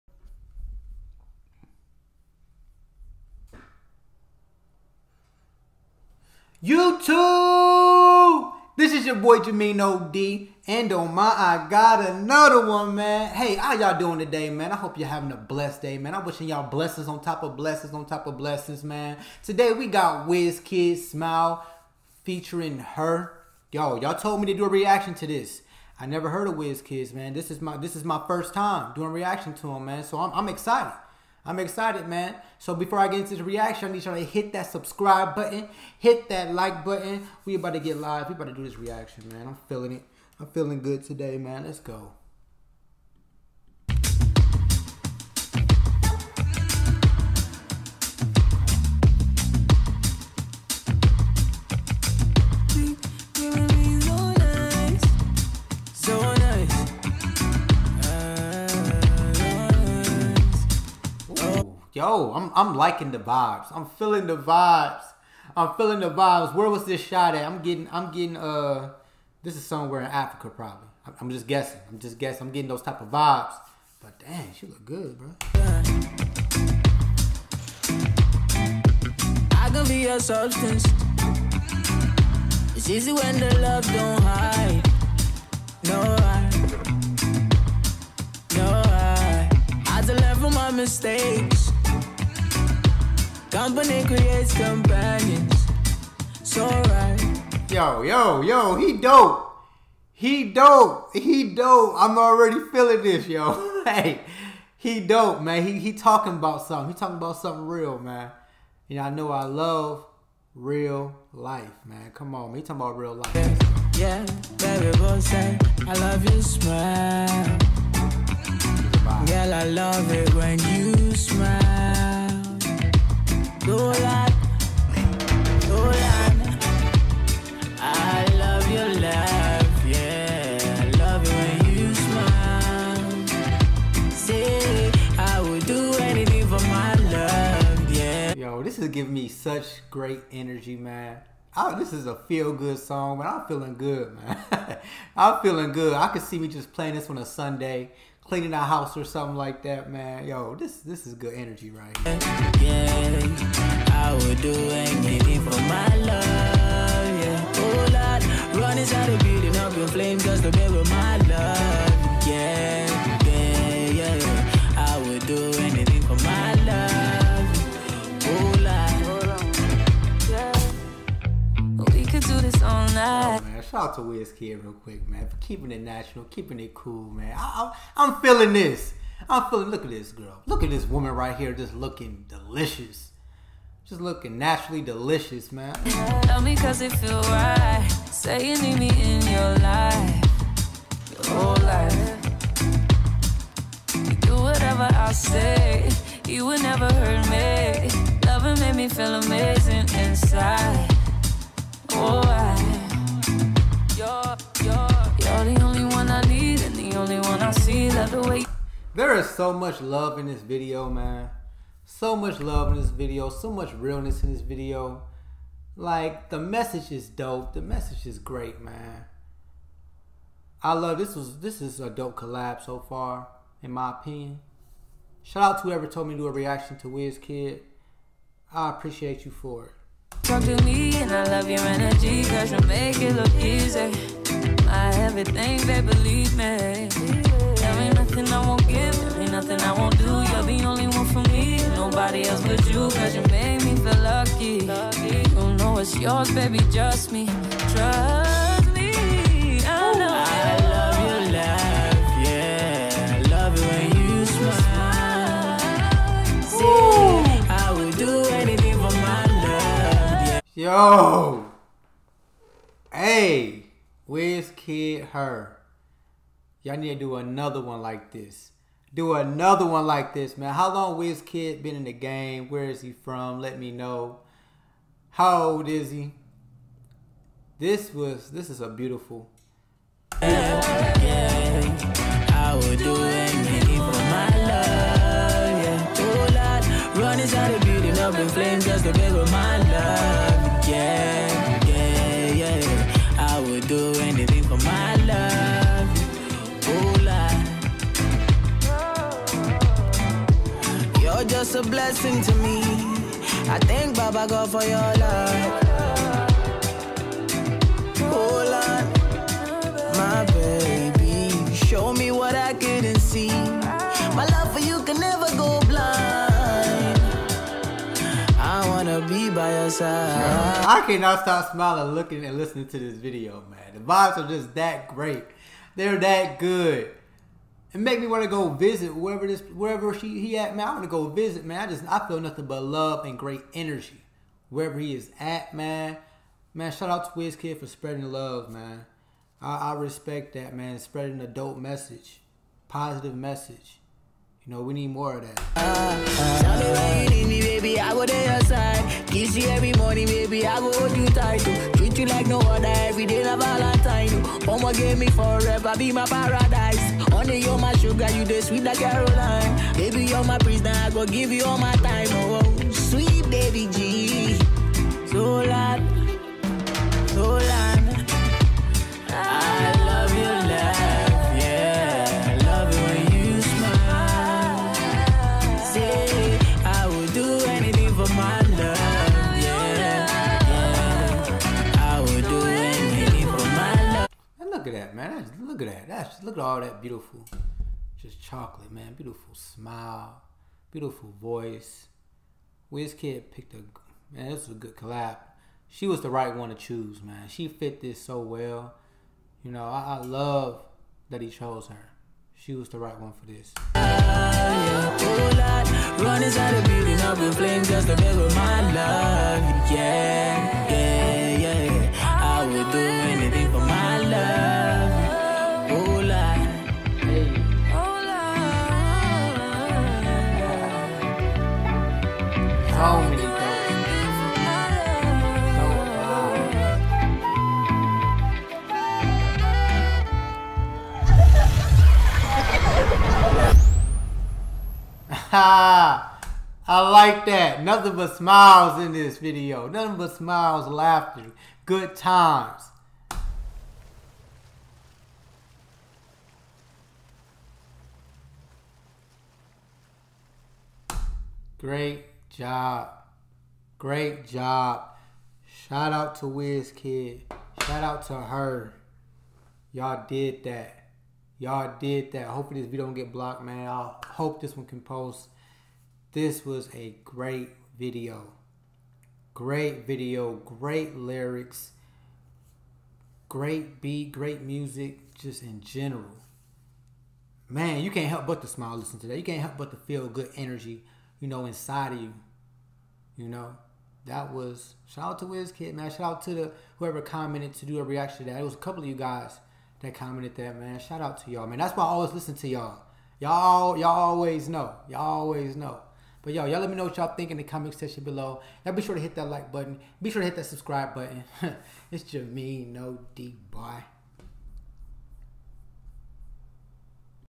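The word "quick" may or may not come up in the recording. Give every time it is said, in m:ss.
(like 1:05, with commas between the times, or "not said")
2:54.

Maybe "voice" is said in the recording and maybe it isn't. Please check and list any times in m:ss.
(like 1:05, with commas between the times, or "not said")
6:31.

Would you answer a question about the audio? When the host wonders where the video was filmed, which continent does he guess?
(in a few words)
Africa.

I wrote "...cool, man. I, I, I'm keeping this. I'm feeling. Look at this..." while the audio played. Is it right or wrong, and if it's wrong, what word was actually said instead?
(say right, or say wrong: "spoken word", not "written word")
wrong: "feeling", not "keeping".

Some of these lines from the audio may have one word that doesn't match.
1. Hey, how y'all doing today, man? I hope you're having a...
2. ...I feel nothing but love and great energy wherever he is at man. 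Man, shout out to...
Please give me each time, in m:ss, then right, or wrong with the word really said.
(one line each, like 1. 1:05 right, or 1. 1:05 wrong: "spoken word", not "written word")
1. 0:13 right
2. 5:31 right.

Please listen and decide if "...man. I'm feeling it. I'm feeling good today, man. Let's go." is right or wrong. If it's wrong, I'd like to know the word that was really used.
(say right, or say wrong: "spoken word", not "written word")
right.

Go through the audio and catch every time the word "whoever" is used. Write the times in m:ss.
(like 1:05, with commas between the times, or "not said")
3:45, 8:06.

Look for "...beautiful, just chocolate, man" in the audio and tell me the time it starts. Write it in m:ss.
6:26.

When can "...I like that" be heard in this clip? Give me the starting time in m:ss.
7:15.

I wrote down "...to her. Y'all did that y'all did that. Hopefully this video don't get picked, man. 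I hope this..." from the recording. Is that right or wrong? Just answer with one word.
wrong.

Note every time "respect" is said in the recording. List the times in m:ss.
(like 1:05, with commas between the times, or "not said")
5:39.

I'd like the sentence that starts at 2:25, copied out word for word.
I could see me just playing this on a Sunday cleaning our house or something like that, man.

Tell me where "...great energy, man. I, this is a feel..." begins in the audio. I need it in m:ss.
2:19.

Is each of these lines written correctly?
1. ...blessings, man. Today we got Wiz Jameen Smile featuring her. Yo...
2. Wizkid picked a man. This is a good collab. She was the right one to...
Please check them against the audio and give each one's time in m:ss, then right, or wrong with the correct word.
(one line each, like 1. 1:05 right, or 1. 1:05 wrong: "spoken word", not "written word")
1. 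0:18 wrong: "Kid", not "Jameen"
2. 6:32 right.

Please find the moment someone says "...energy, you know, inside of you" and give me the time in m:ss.
8:00.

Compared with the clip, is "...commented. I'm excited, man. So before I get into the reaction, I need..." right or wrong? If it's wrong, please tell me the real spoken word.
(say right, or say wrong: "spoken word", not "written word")
wrong: "excited", not "commented".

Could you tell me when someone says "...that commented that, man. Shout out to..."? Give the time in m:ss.
8:09.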